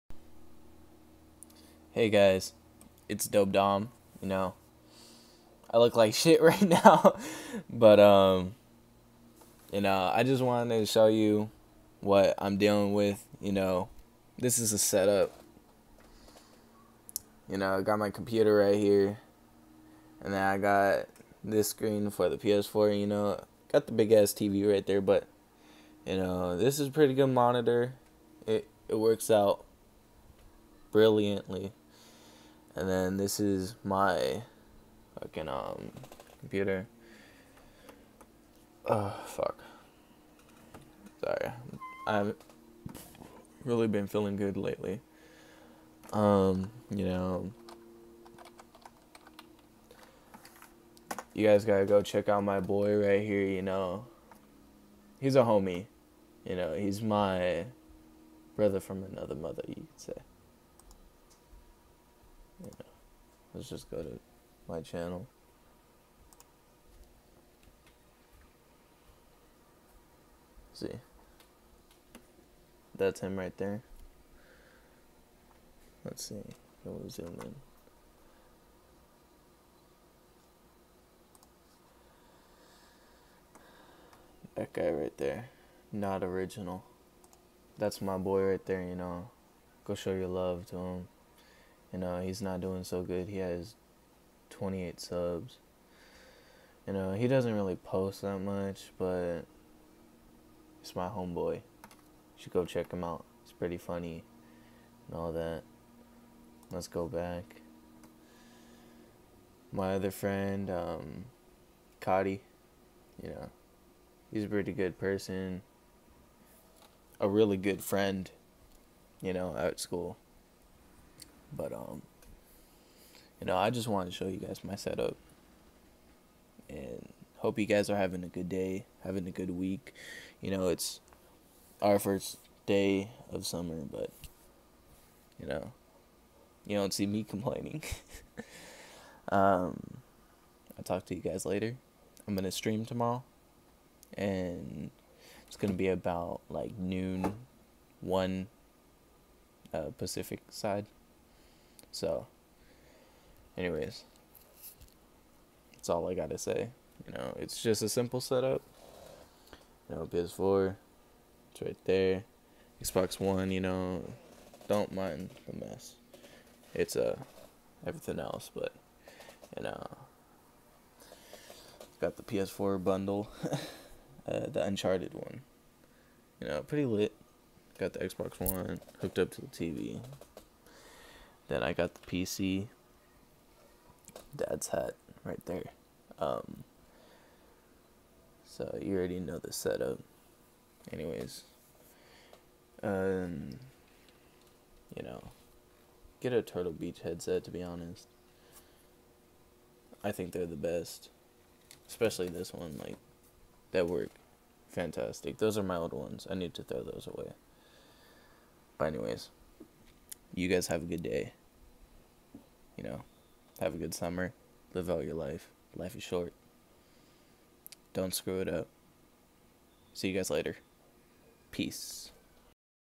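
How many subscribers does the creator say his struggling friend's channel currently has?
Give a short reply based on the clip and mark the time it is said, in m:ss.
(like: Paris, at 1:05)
28, at 1:34.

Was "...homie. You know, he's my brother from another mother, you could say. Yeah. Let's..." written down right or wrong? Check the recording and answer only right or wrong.
right.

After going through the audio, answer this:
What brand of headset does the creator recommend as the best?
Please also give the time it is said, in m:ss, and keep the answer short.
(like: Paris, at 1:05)
Turtle Beach, at 3:16.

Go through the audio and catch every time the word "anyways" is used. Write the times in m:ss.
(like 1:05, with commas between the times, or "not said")
2:33, 3:10, 3:28.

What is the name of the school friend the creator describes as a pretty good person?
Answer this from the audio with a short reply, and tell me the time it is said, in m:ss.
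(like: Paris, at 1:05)
Cotty, at 1:52.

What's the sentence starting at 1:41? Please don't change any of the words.
You should go check him out.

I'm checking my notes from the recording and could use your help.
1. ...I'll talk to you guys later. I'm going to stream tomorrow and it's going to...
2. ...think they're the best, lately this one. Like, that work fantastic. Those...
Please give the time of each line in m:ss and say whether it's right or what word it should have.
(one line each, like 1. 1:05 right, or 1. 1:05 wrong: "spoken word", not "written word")
1. 2:20 right
2. 3:20 wrong: "especially", not "lately".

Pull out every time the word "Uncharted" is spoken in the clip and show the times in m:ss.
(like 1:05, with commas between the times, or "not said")
2:54.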